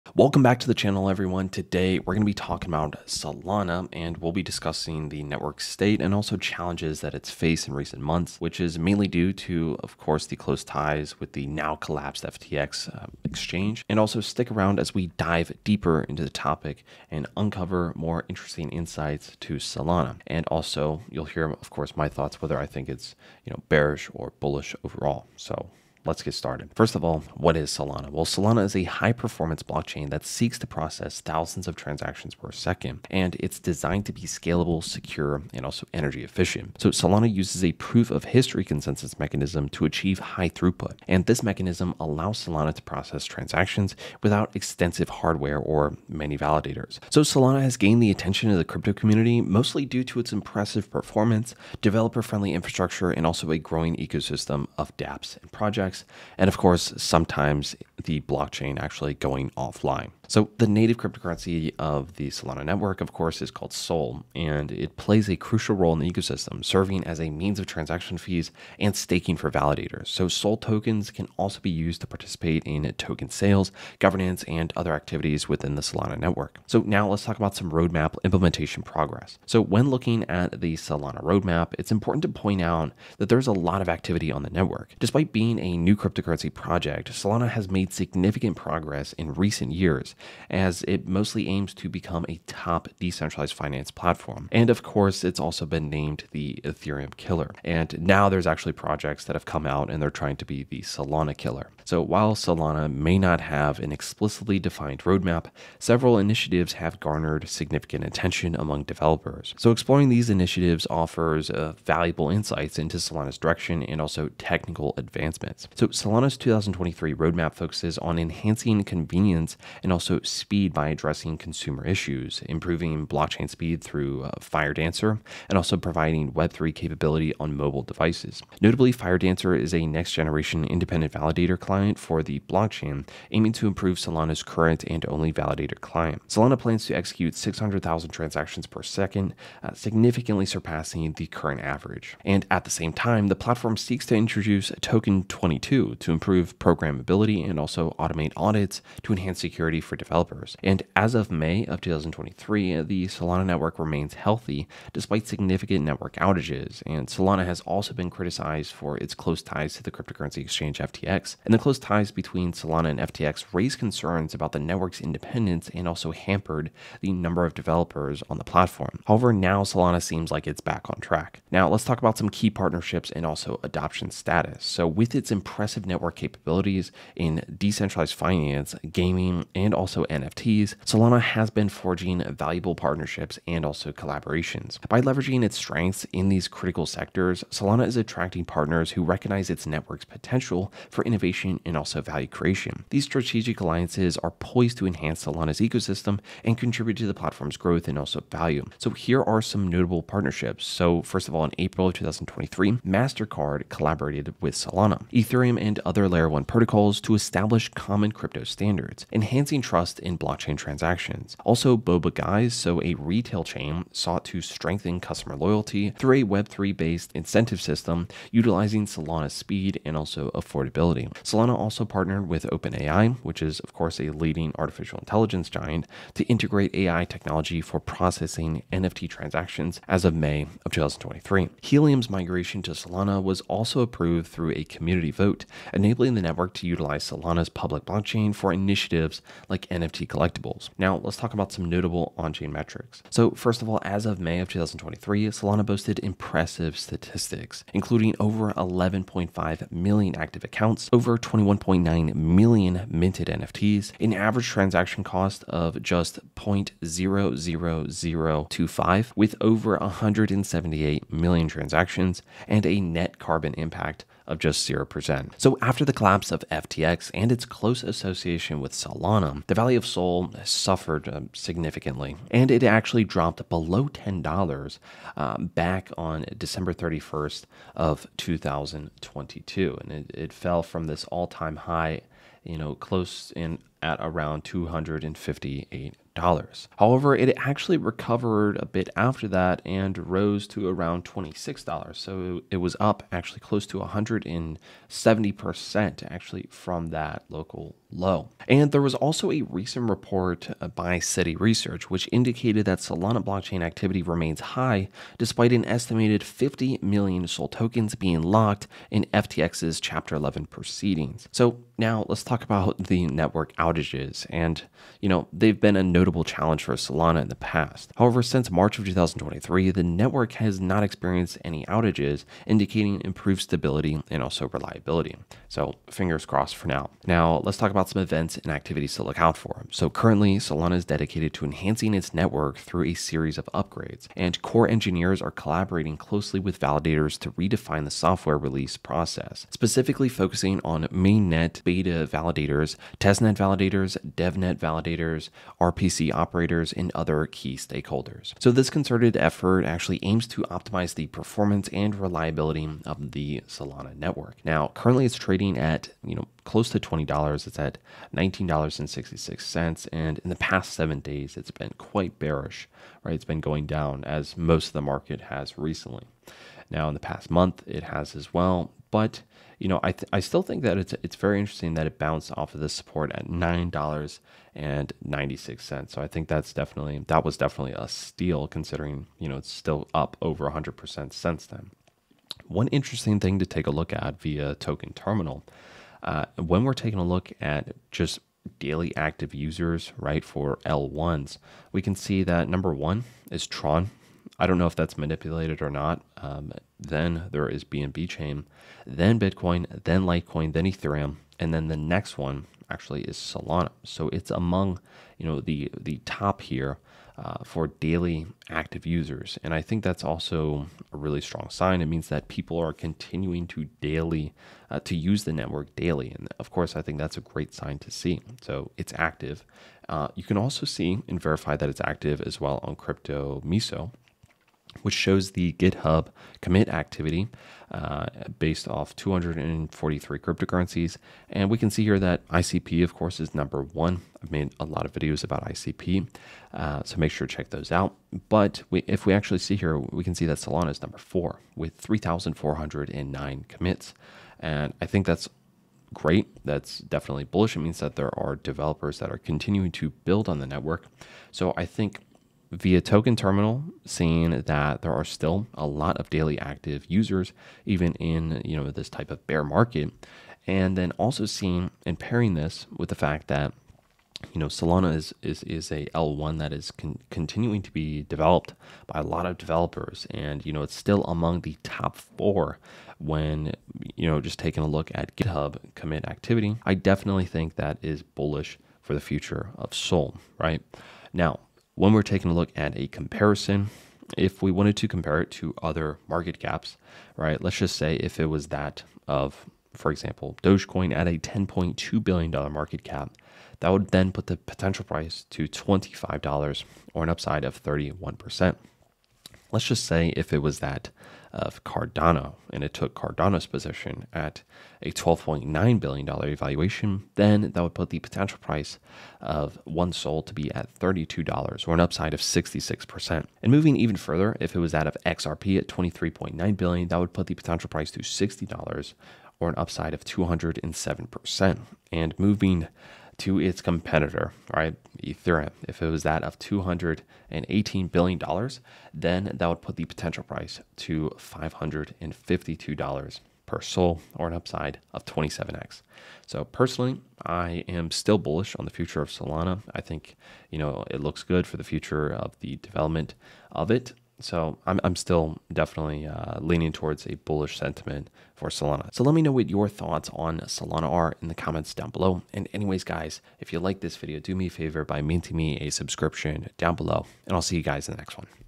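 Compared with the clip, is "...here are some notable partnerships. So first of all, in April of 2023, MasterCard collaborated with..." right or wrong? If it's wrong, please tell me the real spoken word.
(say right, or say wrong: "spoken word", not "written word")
right.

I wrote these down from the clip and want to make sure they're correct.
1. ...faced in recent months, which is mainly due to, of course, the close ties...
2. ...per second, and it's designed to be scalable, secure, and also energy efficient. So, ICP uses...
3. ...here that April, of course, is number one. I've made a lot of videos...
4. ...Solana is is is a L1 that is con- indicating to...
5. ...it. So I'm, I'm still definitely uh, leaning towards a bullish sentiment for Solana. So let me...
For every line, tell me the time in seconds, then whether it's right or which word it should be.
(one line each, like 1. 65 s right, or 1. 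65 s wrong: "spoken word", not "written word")
1. 7 s right
2. 32 s wrong: "Solana", not "ICP"
3. 431 s wrong: "ICP", not "April"
4. 464 s wrong: "continuing", not "indicating"
5. 543 s right.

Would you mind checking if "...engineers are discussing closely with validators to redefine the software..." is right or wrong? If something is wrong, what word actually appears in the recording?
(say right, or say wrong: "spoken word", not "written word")
wrong: "collaborating", not "discussing".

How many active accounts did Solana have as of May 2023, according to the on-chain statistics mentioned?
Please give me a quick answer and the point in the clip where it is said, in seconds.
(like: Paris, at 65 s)
11.5 million, at 248 s.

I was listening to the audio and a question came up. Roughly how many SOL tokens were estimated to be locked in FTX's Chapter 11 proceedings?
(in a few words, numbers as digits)
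50 million.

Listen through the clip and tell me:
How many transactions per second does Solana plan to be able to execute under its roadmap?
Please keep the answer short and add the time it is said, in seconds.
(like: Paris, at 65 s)
600,000, at 137 s.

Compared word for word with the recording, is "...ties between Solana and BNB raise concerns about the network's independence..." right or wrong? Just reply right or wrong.
wrong.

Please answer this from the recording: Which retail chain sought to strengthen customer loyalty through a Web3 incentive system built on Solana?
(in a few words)
Boba Guys.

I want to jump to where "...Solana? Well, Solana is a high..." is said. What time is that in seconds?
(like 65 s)
27 s.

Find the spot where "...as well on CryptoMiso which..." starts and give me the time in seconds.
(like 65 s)
422 s.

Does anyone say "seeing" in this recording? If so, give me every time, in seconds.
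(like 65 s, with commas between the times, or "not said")
453 s, 461 s.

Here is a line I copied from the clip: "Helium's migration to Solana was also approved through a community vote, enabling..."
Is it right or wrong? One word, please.
right.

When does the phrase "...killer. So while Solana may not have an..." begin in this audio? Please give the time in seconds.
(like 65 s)
101 s.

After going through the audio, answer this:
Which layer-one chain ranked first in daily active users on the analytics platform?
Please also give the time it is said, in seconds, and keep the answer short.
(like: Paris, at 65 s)
Tron, at 393 s.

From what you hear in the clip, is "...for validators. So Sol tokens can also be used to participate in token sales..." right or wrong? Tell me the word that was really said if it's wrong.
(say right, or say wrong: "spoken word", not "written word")
right.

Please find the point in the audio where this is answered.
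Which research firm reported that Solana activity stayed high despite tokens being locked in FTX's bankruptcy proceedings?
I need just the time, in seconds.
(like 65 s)
300 s.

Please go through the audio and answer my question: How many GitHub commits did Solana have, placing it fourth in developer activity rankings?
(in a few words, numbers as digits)
3,409.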